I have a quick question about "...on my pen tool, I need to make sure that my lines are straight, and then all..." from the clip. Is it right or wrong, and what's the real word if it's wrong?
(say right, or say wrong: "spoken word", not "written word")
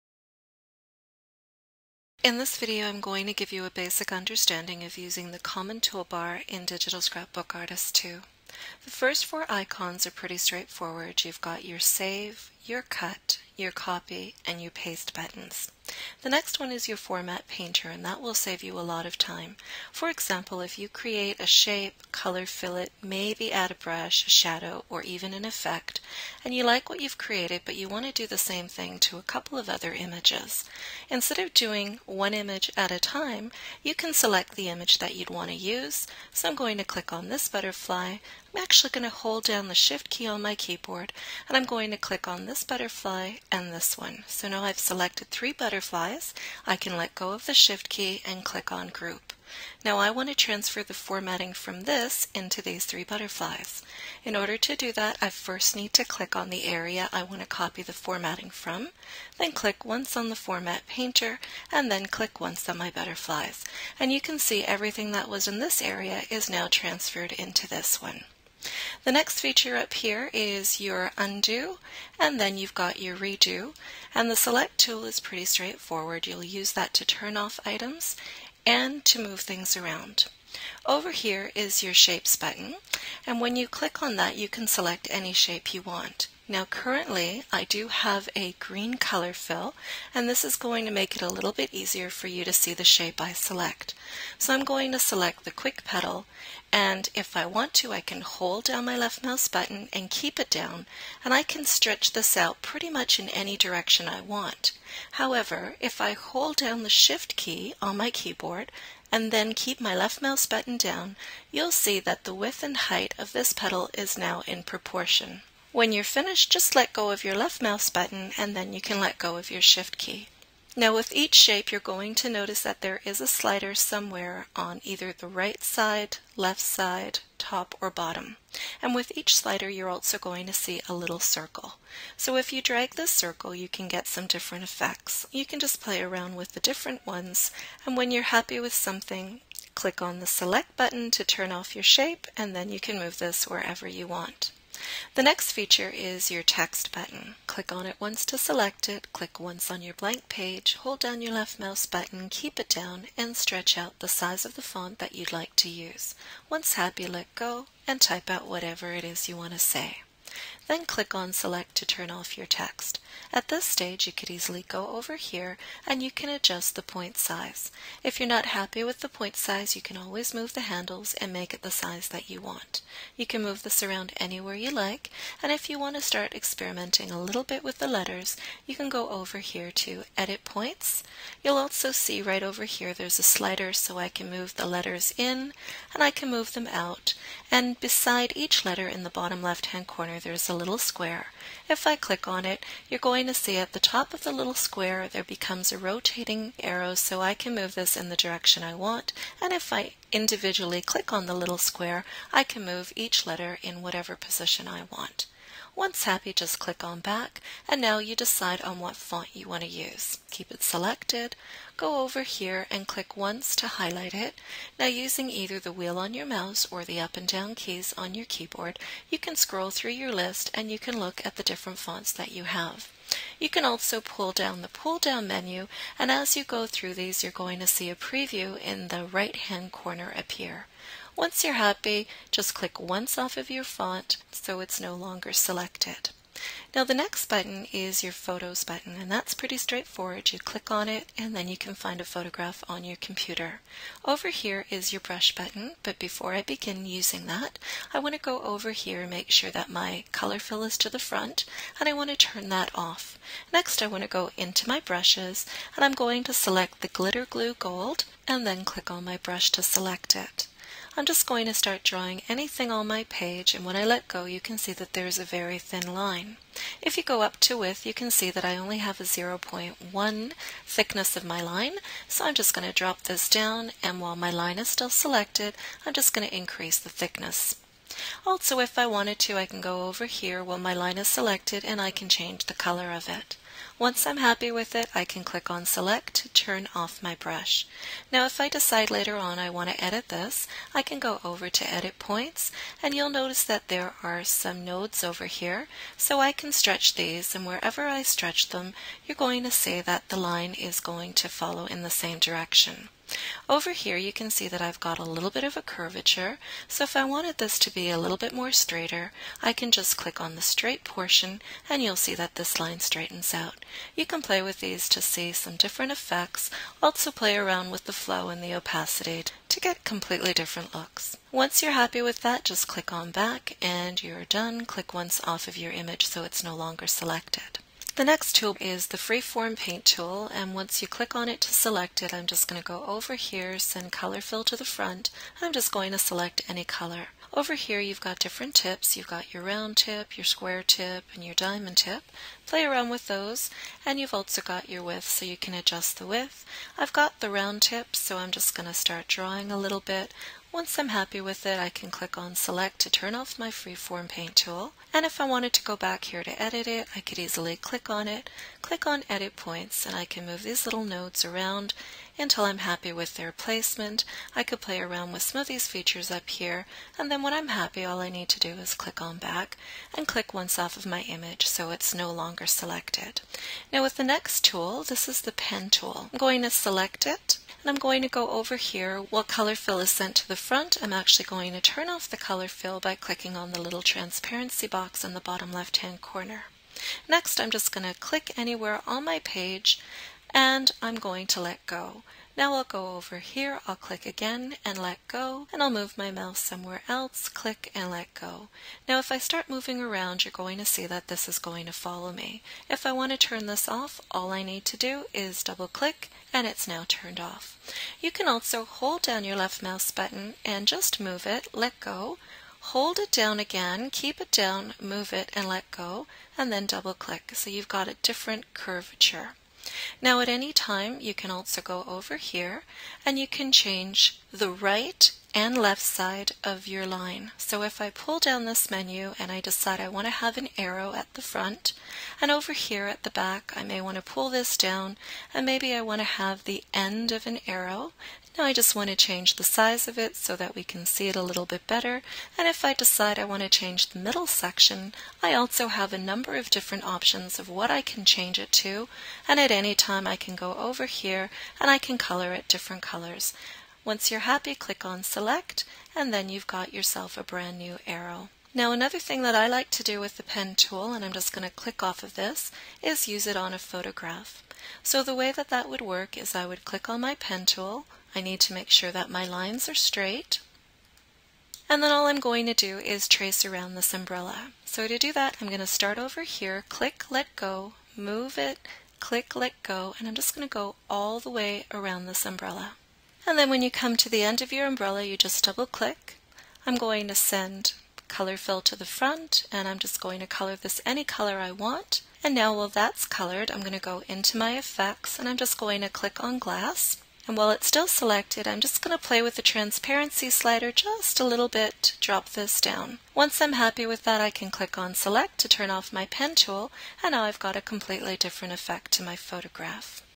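right.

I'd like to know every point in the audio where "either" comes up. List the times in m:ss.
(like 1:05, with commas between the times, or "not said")
2:04, 3:35.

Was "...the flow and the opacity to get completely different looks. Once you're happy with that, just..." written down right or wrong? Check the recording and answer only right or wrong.
right.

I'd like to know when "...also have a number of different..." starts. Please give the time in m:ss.
7:25.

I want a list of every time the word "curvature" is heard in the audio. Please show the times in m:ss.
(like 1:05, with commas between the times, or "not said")
5:05, 6:58.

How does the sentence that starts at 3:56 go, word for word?
Now the next button is your Photos button, and that's pretty straightforward.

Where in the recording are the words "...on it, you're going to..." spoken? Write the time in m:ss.
3:12.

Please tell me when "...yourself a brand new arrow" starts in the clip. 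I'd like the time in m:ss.
7:36.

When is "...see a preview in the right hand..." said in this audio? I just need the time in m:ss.
3:47.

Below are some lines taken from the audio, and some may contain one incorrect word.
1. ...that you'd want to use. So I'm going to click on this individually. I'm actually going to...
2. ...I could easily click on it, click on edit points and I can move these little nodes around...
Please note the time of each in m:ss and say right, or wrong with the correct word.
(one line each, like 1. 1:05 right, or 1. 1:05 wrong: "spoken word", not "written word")
1. 0:34 wrong: "butterfly", not "individually"
2. 5:56 right.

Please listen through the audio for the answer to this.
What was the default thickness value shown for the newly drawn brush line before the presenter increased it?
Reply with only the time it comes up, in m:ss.
4:29.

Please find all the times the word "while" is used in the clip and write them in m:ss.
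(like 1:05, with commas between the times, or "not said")
4:34, 4:40, 8:12, 8:17.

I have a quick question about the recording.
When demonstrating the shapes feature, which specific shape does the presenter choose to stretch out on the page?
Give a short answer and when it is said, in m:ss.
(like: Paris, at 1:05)
quick petal, at 1:35.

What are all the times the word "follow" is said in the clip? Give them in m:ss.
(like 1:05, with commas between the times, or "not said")
5:01, 6:41.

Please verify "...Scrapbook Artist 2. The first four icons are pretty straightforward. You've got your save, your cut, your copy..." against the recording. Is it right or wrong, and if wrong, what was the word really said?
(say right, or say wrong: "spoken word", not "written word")
right.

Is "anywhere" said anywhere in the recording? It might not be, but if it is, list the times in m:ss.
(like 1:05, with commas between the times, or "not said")
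2:54, 6:28.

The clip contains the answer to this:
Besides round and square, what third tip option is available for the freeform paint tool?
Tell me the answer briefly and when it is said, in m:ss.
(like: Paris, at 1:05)
diamond tip, at 5:41.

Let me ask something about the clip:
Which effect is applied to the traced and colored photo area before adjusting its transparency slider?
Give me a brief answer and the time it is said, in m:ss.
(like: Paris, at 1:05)
glass, at 8:16.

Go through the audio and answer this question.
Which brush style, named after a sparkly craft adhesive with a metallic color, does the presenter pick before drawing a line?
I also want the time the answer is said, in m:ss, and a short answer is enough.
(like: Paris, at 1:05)
Glitter Glue Gold, at 4:16.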